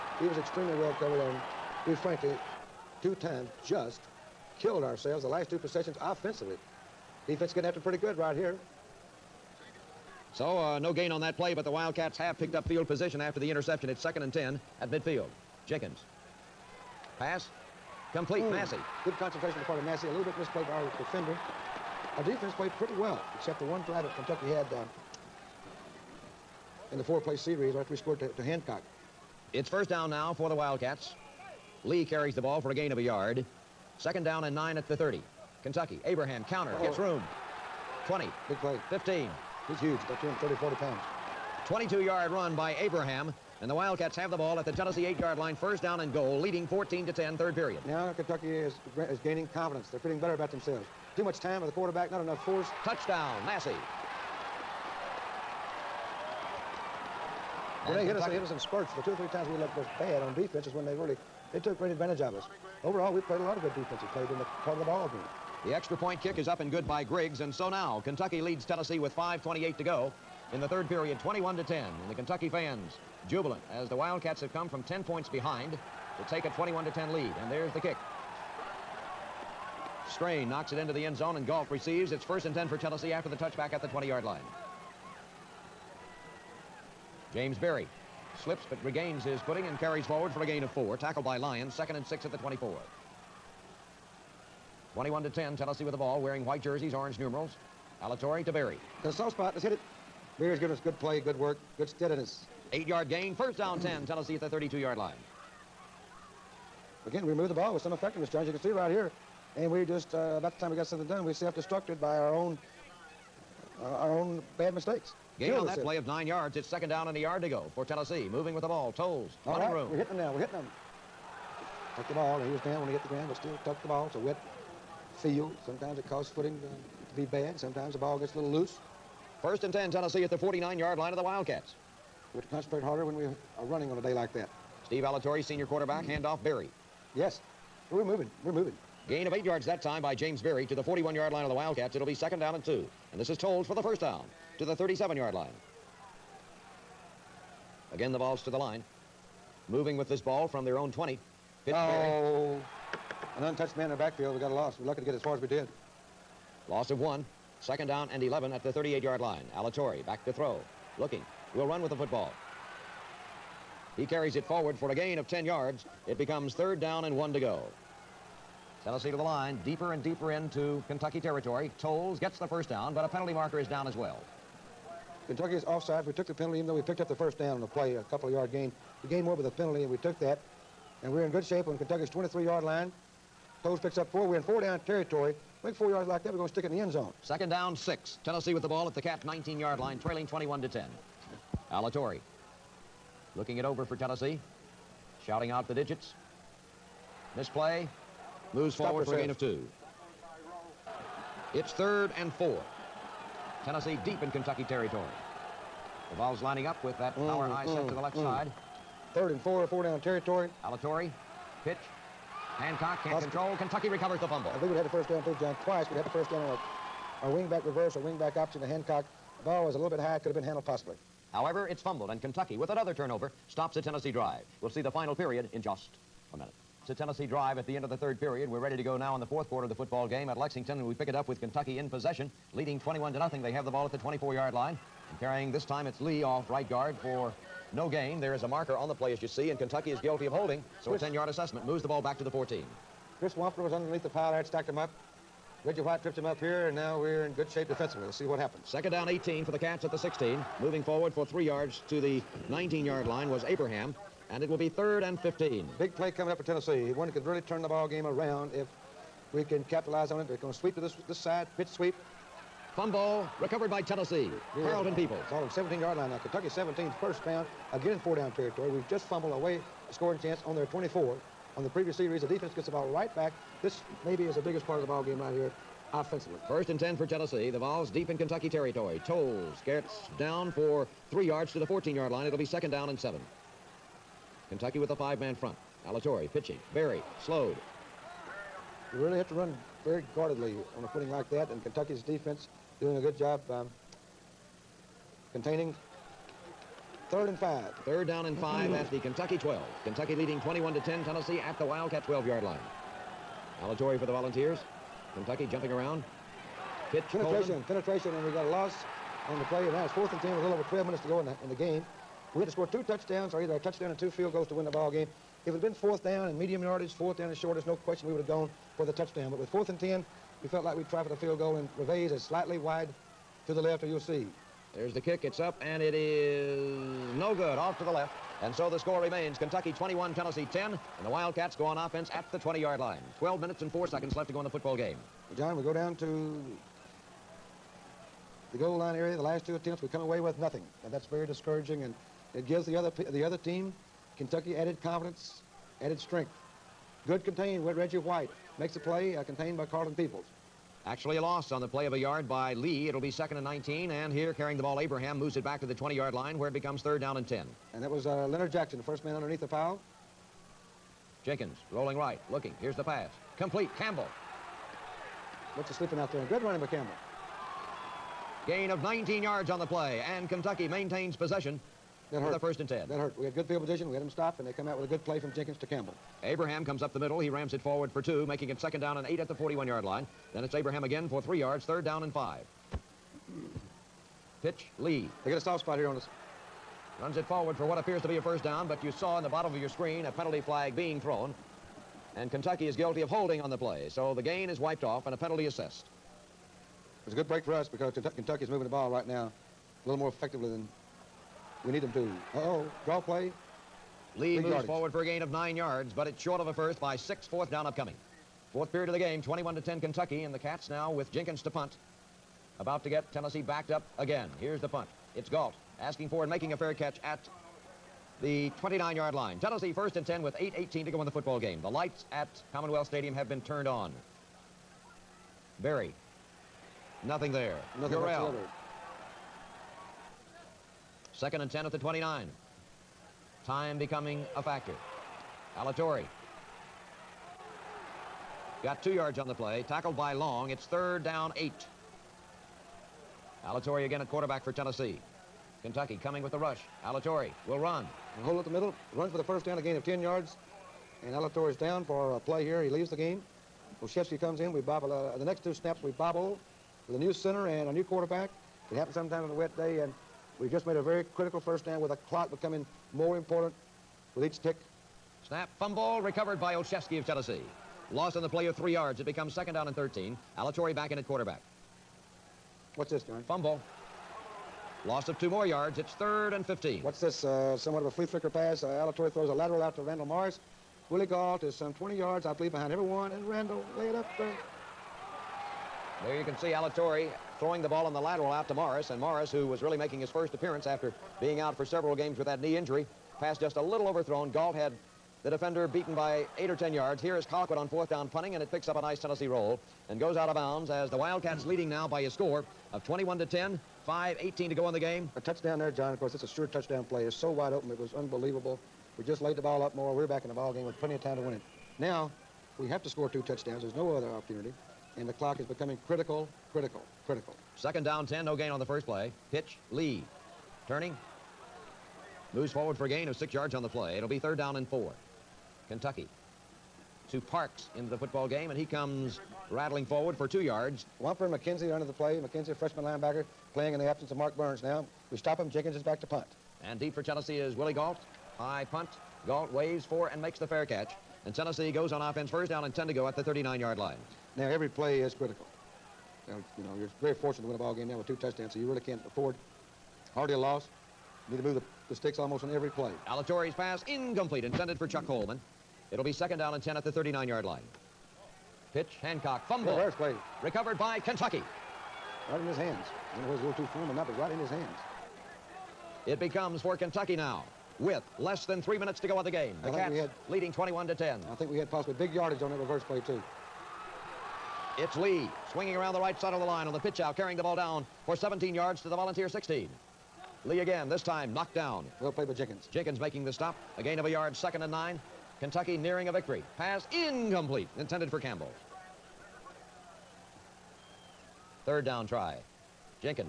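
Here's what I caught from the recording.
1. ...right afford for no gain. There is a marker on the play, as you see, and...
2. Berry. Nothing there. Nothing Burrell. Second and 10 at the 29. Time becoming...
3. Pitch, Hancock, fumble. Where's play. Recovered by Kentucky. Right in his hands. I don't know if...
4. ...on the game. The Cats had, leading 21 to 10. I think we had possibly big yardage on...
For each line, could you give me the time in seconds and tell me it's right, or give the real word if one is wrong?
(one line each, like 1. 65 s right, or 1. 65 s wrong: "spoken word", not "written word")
1. 236 s wrong: "guard", not "afford"
2. 425 s right
3. 558 s right
4. 569 s right.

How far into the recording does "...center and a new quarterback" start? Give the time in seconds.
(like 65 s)
457 s.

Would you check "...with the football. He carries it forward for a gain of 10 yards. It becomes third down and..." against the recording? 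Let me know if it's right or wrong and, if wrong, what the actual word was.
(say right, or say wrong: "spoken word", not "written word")
right.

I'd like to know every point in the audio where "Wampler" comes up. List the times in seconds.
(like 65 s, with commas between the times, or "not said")
243 s, 530 s.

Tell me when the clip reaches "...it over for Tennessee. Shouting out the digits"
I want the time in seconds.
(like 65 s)
193 s.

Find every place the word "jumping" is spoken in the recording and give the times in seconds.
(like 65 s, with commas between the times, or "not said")
305 s.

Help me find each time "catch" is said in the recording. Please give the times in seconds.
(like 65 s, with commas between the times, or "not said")
416 s, 540 s.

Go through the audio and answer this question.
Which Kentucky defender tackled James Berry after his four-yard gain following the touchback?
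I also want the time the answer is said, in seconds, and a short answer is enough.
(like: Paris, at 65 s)
Lyons, at 91 s.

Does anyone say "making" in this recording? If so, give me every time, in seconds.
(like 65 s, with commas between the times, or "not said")
378 s, 416 s, 489 s, 582 s.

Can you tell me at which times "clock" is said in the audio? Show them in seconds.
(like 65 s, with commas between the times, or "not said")
462 s, 515 s.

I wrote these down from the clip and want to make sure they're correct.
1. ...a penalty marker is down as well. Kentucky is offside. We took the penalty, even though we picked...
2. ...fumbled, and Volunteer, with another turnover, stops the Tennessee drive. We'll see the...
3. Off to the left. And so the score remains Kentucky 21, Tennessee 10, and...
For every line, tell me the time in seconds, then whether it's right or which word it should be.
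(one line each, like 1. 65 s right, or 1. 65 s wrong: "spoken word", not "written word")
1. 173 s right
2. 221 s wrong: "Kentucky", not "Volunteer"
3. 327 s right.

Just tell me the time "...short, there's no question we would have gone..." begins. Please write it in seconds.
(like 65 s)
317 s.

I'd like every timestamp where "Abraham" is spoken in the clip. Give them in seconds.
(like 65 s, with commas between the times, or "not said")
36 s, 42 s, 253 s, 354 s, 376 s, 380 s.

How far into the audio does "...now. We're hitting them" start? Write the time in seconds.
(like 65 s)
120 s.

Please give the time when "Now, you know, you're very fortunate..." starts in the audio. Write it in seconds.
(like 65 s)
546 s.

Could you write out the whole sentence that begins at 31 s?
Lee carries the ball for a gain of a yard.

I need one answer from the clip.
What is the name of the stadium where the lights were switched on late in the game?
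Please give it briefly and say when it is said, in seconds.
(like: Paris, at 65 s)
Commonwealth Stadium, at 422 s.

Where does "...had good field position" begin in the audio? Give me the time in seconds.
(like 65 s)
373 s.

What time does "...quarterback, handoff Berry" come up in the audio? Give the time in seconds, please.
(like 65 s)
135 s.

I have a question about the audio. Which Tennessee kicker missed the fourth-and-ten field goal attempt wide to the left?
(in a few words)
Reveiz.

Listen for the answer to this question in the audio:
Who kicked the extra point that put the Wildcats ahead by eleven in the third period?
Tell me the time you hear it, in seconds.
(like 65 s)
67 s.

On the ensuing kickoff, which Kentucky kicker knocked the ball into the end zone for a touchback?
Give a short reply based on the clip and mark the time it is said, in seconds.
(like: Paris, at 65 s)
Strain, at 80 s.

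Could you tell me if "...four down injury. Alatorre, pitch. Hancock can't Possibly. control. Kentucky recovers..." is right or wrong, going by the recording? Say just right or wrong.
wrong.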